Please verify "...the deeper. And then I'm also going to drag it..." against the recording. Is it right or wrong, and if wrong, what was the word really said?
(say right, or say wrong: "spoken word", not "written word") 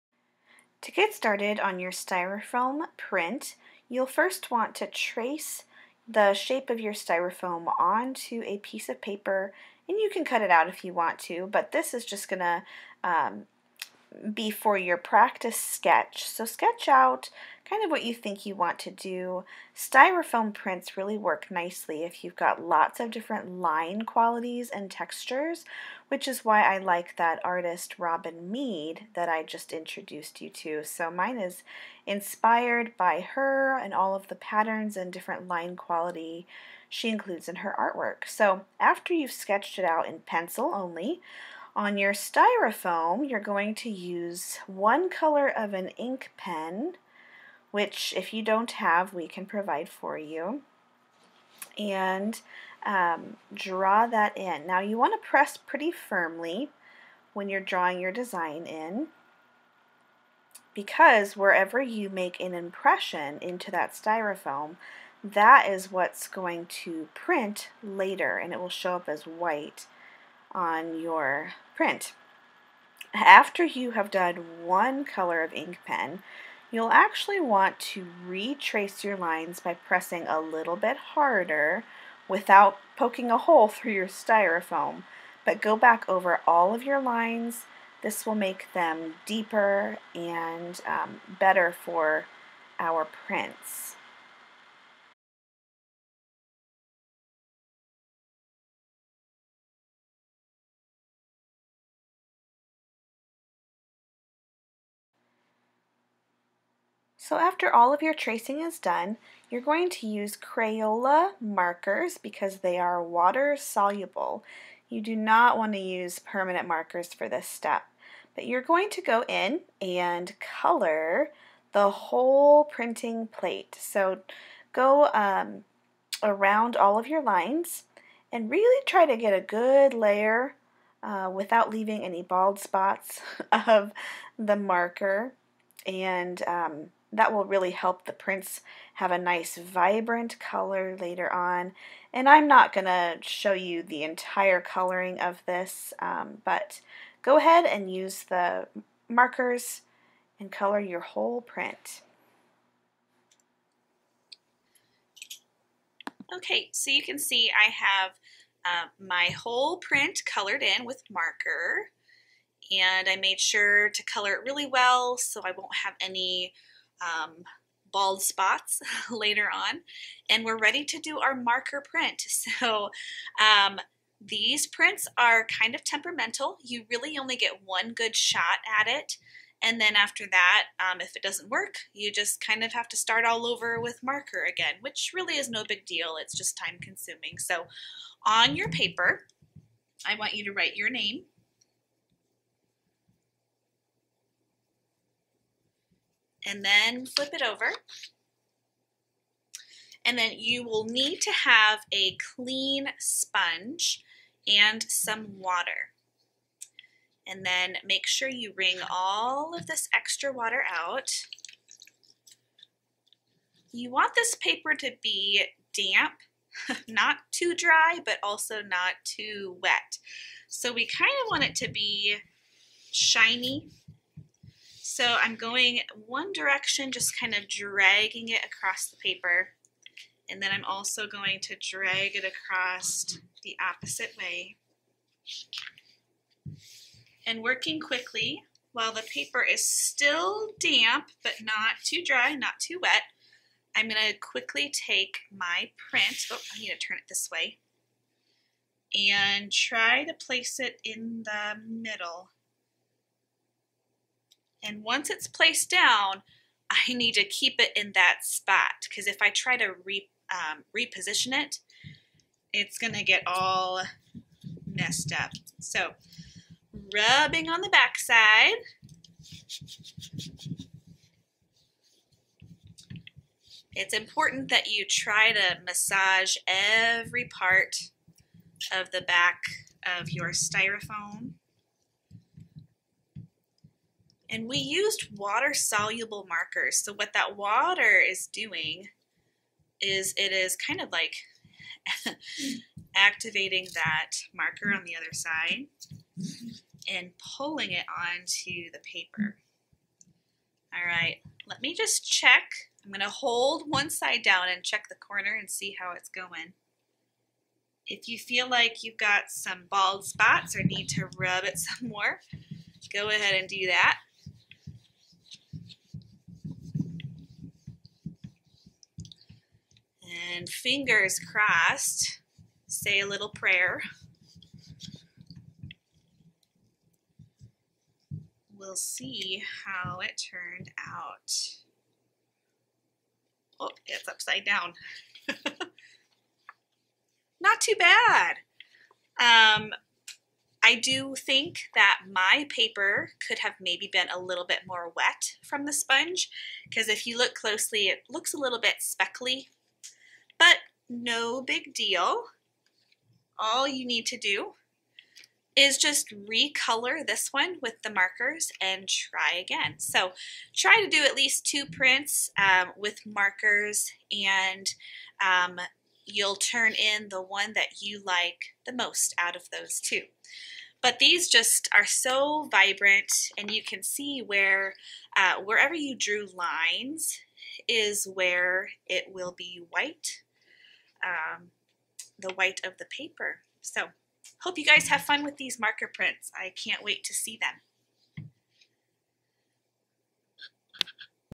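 wrong: "paper", not "deeper".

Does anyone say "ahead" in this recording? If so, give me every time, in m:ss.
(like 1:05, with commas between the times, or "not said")
2:27, 5:13.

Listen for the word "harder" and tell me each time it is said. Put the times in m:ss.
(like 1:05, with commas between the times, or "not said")
1:21.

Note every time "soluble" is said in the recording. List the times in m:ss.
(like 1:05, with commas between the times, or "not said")
1:53, 4:45.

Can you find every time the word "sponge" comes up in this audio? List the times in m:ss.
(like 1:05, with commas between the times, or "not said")
3:22, 5:45.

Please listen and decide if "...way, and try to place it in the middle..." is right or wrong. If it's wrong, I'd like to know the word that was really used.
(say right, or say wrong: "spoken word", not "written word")
right.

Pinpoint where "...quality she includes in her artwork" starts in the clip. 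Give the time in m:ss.
0:35.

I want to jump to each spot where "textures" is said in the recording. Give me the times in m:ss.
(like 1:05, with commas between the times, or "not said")
0:24.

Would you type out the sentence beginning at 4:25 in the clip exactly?
So rubbing on the back side.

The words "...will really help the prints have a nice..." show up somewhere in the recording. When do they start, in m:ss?
2:17.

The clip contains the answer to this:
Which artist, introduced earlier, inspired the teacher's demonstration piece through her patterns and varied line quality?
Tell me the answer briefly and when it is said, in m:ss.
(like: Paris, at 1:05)
Robin Meade, at 0:27.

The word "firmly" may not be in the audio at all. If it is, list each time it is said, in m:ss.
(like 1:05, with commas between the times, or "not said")
0:55.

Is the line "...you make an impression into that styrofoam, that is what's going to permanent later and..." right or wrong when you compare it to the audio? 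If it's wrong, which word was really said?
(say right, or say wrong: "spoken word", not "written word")
wrong: "print", not "permanent".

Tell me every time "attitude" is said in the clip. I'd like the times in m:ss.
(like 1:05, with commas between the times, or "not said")
not said.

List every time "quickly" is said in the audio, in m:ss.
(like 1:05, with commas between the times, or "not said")
3:57, 4:04.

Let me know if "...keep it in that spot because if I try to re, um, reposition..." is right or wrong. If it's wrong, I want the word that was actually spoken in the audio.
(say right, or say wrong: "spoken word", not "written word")
right.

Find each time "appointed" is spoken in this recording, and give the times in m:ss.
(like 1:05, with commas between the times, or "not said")
not said.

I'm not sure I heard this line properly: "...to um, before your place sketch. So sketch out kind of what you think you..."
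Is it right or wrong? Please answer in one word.
wrong.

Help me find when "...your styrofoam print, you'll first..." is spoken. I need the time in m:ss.
0:01.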